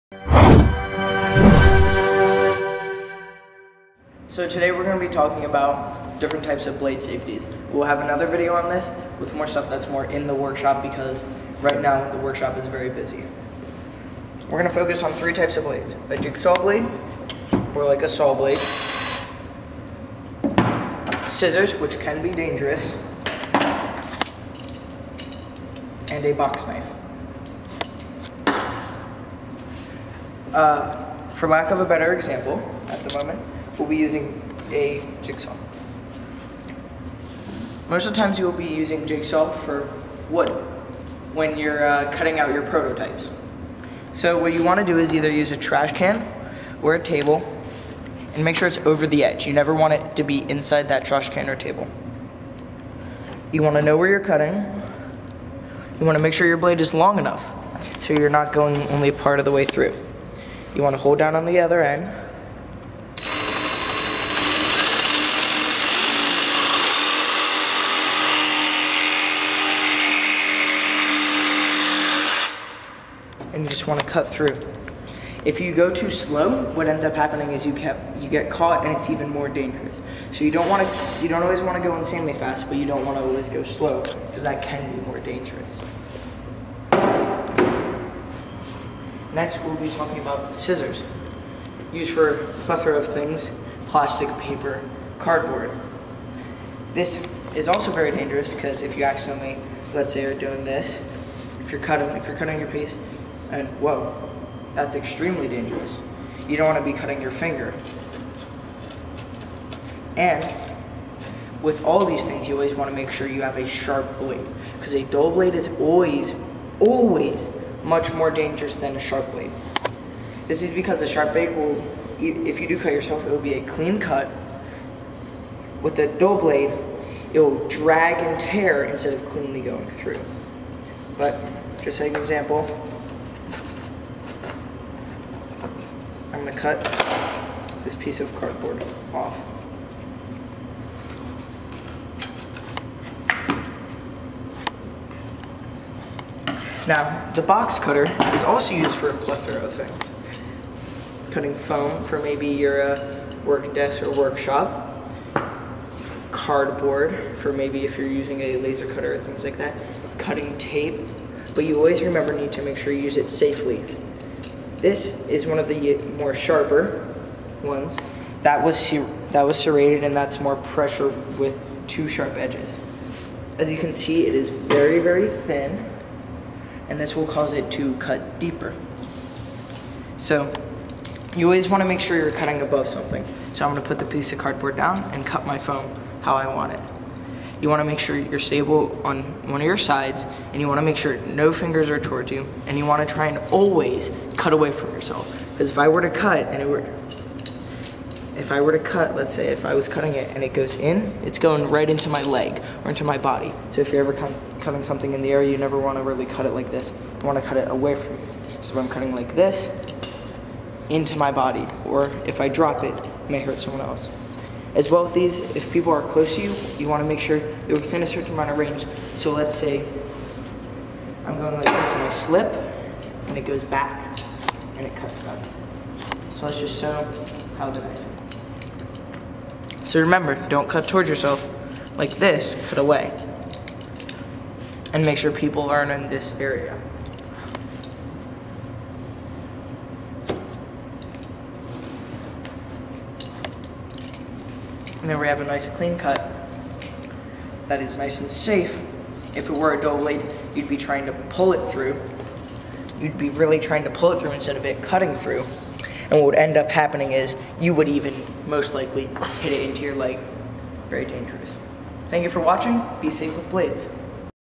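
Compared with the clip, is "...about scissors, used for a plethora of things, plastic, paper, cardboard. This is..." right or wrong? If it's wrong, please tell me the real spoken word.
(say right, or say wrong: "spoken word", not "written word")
right.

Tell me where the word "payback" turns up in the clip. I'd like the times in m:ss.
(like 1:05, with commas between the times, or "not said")
not said.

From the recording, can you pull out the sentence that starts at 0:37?
Most of the times you will be using jigsaw for wood when you're uh, cutting out your prototypes.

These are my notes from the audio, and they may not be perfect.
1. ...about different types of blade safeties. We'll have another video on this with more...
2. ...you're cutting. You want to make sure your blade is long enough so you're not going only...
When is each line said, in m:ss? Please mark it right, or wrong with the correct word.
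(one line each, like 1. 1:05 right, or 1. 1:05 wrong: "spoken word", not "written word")
1. 0:05 right
2. 0:54 right.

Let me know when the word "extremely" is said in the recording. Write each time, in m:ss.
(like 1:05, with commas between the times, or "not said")
1:44.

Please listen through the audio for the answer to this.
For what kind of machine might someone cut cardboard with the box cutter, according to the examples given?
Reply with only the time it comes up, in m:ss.
2:38.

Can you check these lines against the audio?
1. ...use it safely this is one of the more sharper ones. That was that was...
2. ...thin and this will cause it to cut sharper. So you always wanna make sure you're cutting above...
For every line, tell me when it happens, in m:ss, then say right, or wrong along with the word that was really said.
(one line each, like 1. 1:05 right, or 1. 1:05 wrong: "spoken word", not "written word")
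1. 2:43 right
2. 2:55 wrong: "deeper", not "sharper".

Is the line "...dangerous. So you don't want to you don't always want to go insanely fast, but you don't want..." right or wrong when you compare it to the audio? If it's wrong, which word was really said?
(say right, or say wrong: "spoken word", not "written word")
right.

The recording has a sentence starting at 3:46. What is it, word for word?
So let's just show how the knife.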